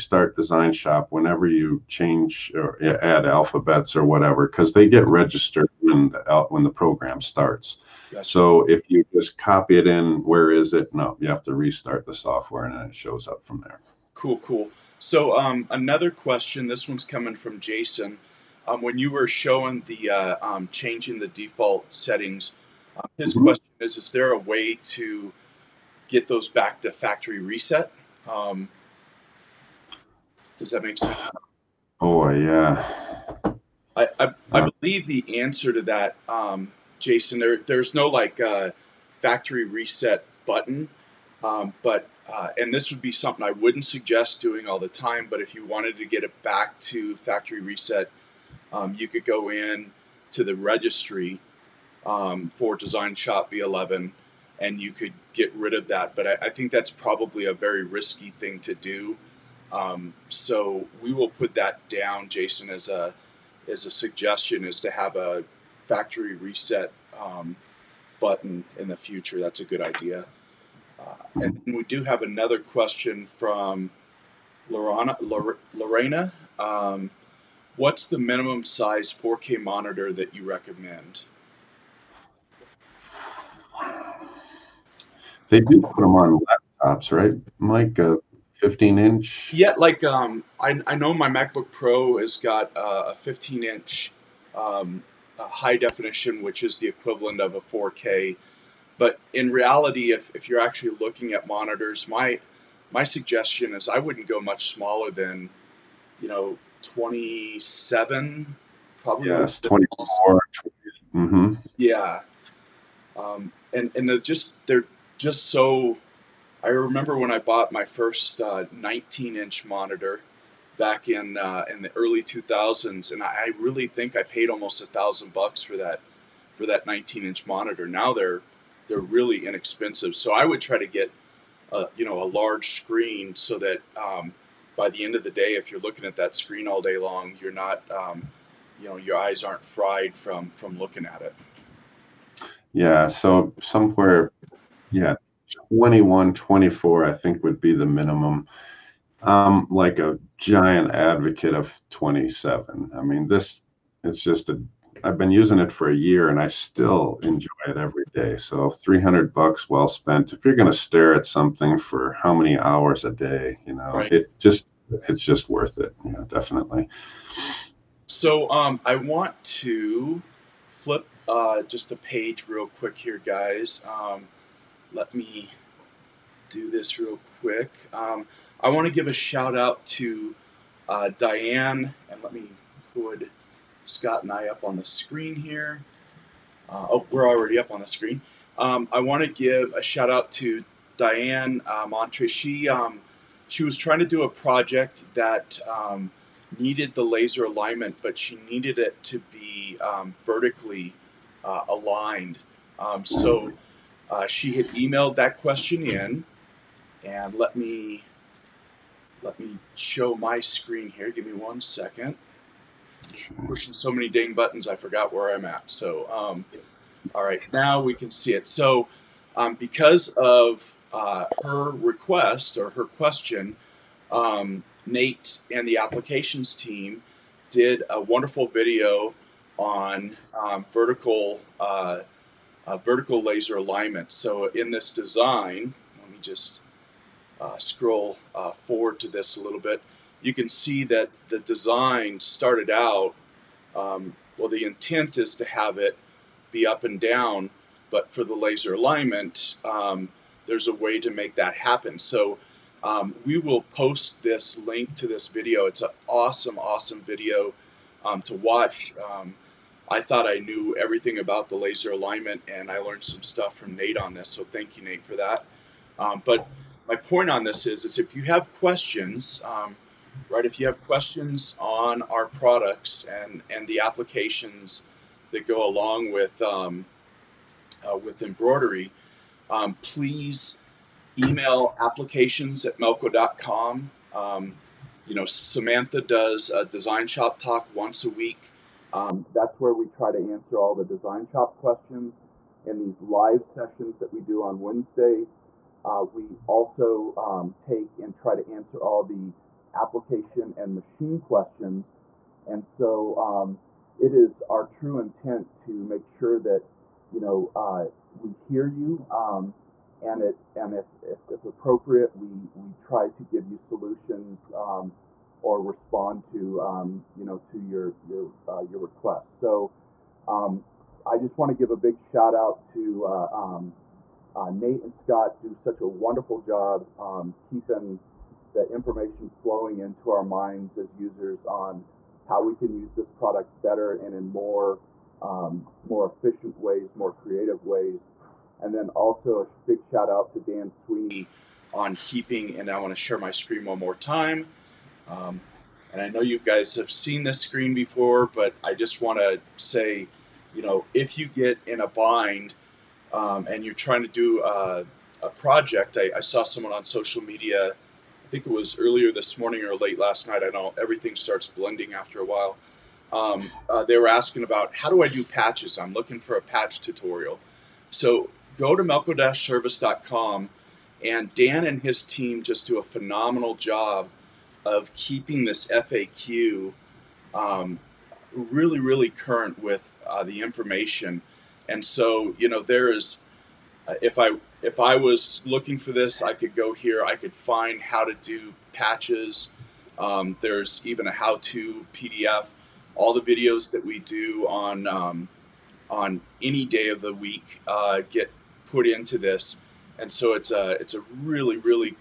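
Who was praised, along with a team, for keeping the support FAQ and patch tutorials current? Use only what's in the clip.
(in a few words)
Dan Sweeney.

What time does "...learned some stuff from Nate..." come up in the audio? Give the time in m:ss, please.
4:22.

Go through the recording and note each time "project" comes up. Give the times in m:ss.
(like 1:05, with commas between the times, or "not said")
3:14, 5:55.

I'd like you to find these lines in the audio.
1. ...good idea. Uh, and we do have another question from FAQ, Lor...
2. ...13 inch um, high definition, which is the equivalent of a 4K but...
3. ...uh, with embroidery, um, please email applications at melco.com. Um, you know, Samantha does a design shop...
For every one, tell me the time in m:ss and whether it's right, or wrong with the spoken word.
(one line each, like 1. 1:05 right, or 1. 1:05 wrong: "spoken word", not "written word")
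1. 1:09 wrong: "Lorana", not "FAQ"
2. 1:33 wrong: "15", not "13"
3. 4:37 right.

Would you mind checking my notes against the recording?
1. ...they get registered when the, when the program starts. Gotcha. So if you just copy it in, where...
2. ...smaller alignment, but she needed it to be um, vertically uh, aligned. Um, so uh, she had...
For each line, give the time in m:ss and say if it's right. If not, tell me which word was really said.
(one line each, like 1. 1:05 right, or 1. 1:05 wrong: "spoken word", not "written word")
1. 0:04 right
2. 3:17 wrong: "laser", not "smaller".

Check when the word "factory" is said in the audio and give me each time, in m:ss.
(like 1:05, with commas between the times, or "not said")
0:26, 0:39, 0:47, 1:05.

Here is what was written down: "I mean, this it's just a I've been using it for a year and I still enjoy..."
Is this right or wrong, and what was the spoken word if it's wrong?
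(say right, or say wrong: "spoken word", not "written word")
right.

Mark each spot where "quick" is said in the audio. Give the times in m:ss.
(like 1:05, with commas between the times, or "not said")
2:52, 2:57.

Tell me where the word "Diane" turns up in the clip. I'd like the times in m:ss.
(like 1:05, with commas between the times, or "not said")
3:01, 3:10.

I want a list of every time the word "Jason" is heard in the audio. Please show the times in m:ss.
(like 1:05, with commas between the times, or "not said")
0:17, 0:36, 1:02.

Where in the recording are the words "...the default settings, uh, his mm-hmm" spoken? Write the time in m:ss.
0:21.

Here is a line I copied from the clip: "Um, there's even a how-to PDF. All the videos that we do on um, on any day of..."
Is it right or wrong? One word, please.
right.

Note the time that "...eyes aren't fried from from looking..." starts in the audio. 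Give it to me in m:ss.
2:19.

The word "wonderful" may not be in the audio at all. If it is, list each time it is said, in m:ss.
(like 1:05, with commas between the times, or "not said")
3:48, 5:25.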